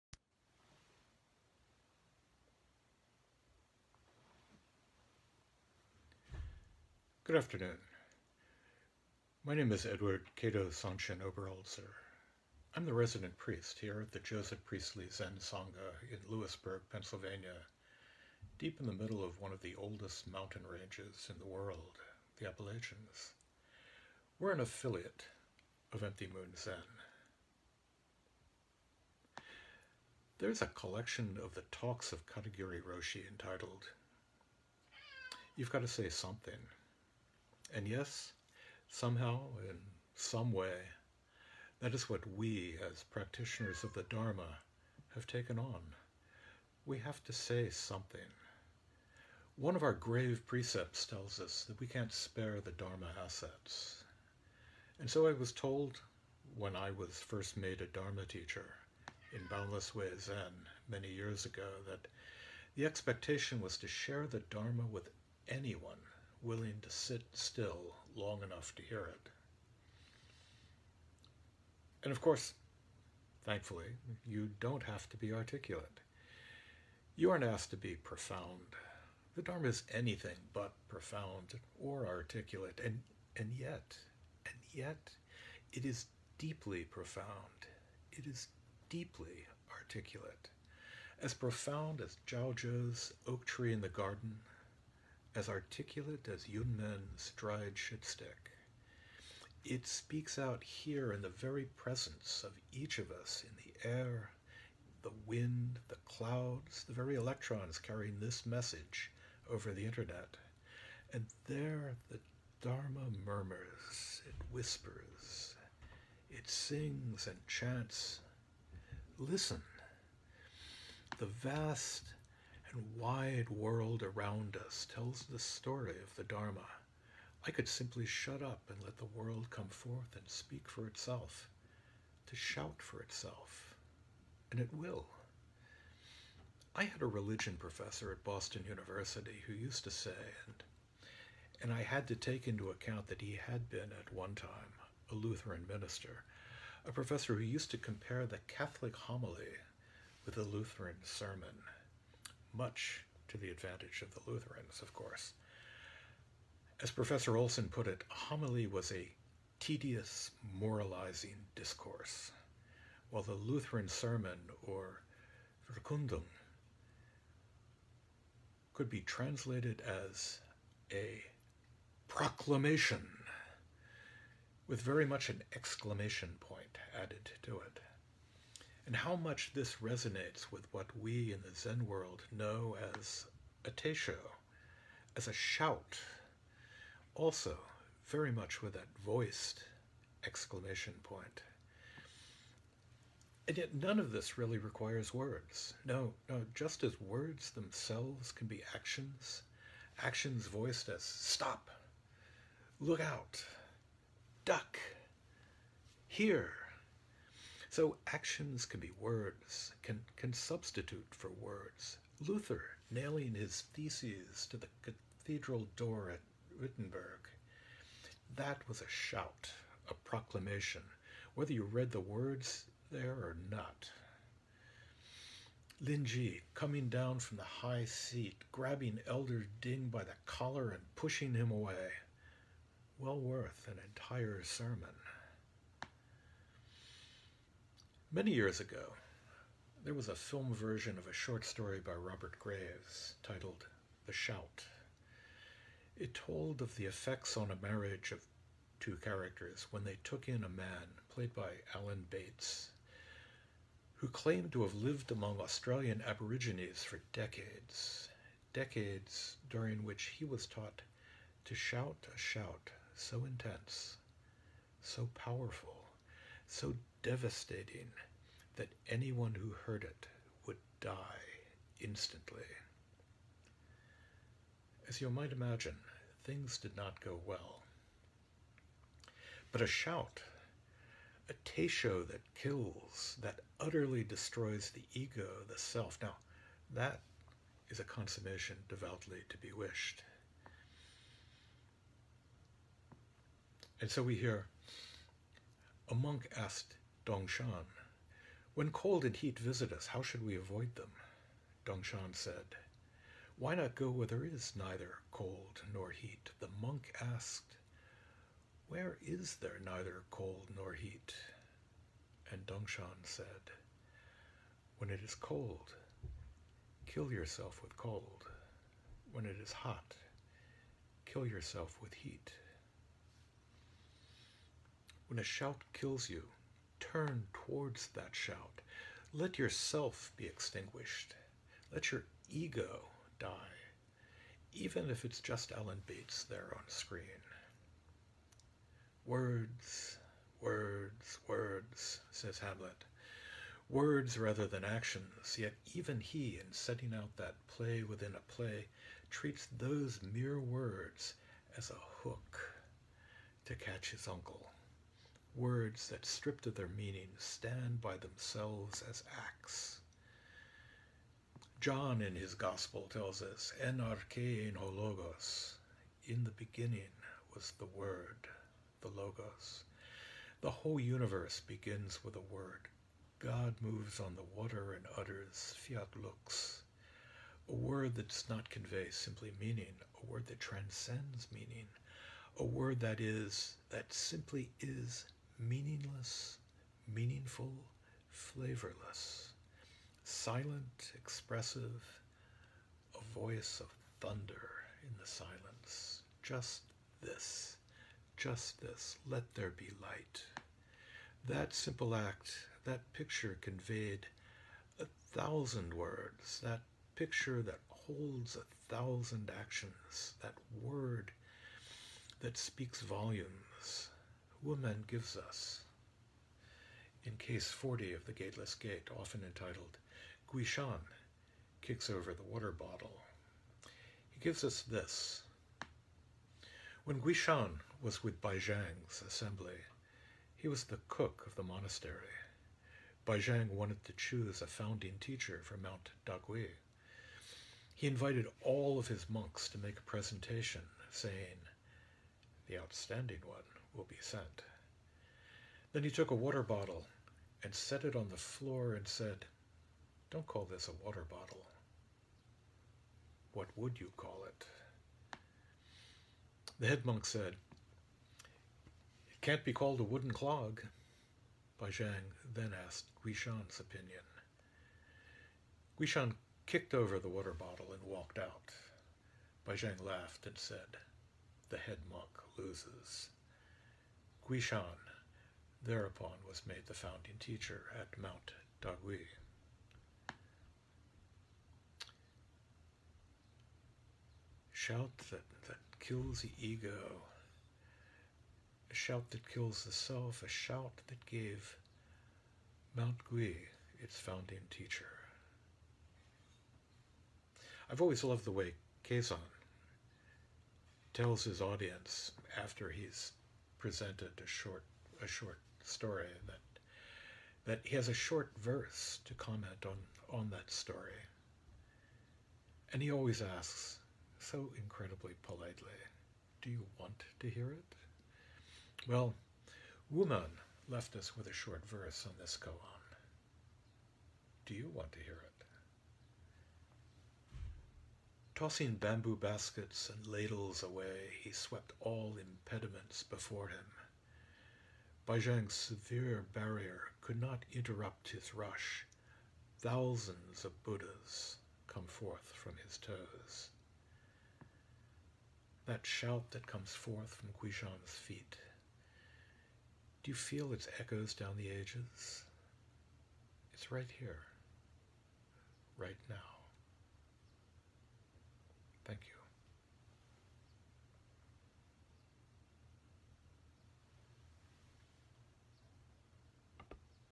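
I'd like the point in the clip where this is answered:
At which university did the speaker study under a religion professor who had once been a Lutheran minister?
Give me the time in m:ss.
2:18.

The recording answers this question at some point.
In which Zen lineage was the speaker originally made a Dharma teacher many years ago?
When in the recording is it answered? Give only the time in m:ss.
0:59.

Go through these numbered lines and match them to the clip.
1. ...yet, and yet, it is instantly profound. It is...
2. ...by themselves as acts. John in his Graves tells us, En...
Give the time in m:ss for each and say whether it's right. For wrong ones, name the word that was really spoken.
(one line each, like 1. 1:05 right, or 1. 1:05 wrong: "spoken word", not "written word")
1. 1:23 wrong: "deeply", not "instantly"
2. 5:57 wrong: "Gospel", not "Graves".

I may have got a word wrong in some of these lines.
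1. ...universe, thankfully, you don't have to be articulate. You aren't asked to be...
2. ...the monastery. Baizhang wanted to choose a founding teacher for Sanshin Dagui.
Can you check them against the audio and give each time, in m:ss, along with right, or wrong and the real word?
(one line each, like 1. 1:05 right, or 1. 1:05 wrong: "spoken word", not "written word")
1. 1:12 wrong: "course", not "universe"
2. 7:11 wrong: "Mount", not "Sanshin".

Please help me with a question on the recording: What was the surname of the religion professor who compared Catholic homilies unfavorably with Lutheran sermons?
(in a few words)
Olson.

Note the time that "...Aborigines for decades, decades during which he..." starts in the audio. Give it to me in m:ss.
4:16.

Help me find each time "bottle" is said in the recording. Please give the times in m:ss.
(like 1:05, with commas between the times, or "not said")
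7:02, 7:26, 7:31, 7:47.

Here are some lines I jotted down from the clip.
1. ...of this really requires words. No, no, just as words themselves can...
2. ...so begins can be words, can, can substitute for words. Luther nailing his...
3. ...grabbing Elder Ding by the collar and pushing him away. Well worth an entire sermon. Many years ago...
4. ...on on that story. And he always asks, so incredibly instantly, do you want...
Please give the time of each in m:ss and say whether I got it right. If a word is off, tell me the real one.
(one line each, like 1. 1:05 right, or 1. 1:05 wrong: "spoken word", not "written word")
1. 3:13 right
2. 3:27 wrong: "actions", not "begins"
3. 3:48 right
4. 8:29 wrong: "politely", not "instantly".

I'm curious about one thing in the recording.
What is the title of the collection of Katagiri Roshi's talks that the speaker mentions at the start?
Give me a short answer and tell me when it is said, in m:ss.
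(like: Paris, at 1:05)
You've Got to Say Something, at 0:35.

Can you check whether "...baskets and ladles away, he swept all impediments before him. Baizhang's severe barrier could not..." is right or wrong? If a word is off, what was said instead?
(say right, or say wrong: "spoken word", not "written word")
right.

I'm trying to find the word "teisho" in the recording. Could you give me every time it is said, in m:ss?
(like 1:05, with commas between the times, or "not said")
3:03, 4:41.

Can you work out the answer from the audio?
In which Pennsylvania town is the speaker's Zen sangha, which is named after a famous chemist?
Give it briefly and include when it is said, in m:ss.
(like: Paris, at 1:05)
Lewisburg, at 0:16.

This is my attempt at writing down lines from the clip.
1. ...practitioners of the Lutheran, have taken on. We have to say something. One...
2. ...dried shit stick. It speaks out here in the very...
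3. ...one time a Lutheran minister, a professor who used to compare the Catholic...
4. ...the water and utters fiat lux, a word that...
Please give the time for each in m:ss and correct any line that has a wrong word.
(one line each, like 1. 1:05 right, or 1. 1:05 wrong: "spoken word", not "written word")
1. 0:43 wrong: "Dharma", not "Lutheran"
2. 1:37 right
3. 2:24 right
4. 6:14 right.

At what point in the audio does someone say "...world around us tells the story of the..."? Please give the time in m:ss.
2:03.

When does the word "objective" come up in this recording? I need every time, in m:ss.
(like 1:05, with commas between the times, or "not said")
not said.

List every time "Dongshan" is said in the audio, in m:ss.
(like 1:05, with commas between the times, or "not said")
4:57, 5:01, 5:12.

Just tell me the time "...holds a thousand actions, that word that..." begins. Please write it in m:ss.
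6:47.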